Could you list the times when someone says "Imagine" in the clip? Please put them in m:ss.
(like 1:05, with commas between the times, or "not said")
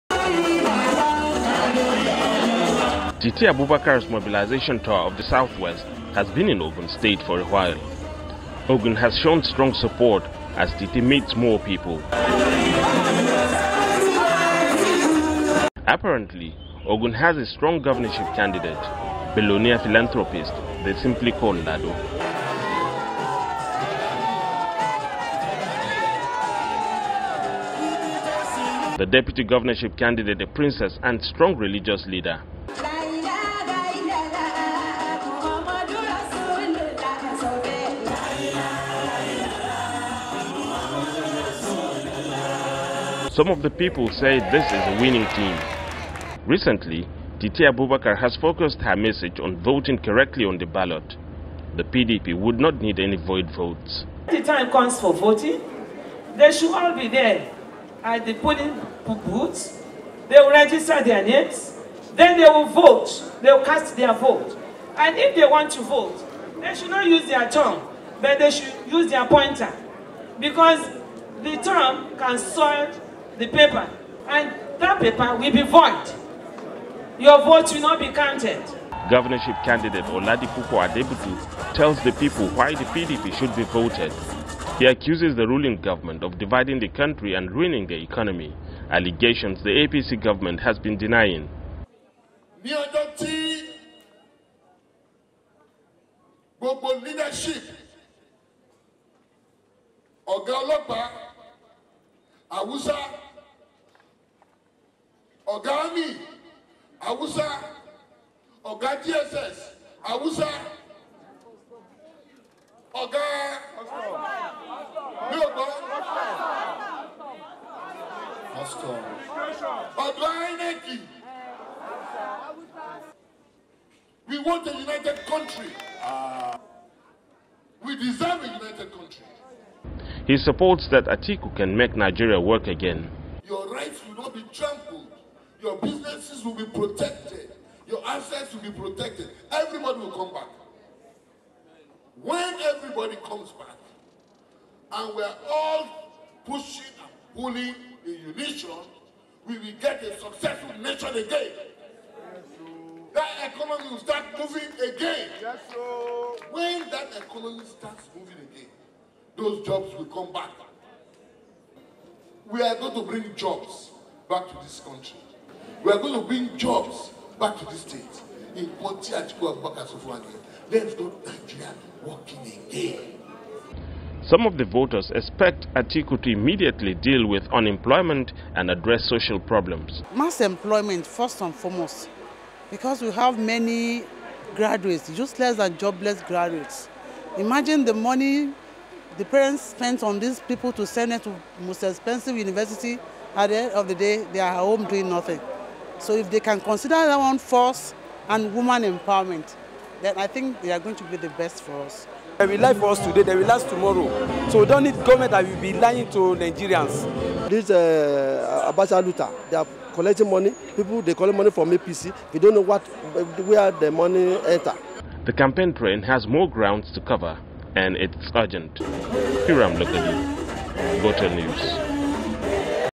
3:07.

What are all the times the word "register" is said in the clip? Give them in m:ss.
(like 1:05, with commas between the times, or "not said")
1:00.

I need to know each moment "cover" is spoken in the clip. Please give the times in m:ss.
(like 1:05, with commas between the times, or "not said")
3:37.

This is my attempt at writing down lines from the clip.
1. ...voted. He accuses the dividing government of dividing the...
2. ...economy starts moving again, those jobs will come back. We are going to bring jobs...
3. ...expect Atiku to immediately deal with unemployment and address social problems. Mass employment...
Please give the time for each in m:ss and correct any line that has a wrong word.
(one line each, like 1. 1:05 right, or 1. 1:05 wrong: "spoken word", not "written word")
1. 1:23 wrong: "ruling", not "dividing"
2. 2:37 right
3. 2:55 right.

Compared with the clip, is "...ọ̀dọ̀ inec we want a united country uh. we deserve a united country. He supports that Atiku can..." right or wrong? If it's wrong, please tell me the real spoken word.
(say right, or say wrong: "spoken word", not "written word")
right.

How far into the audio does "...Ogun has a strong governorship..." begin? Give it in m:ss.
0:16.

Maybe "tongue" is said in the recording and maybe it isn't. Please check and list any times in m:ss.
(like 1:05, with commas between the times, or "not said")
1:07, 1:11.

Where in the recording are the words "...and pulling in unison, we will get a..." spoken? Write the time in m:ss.
2:27.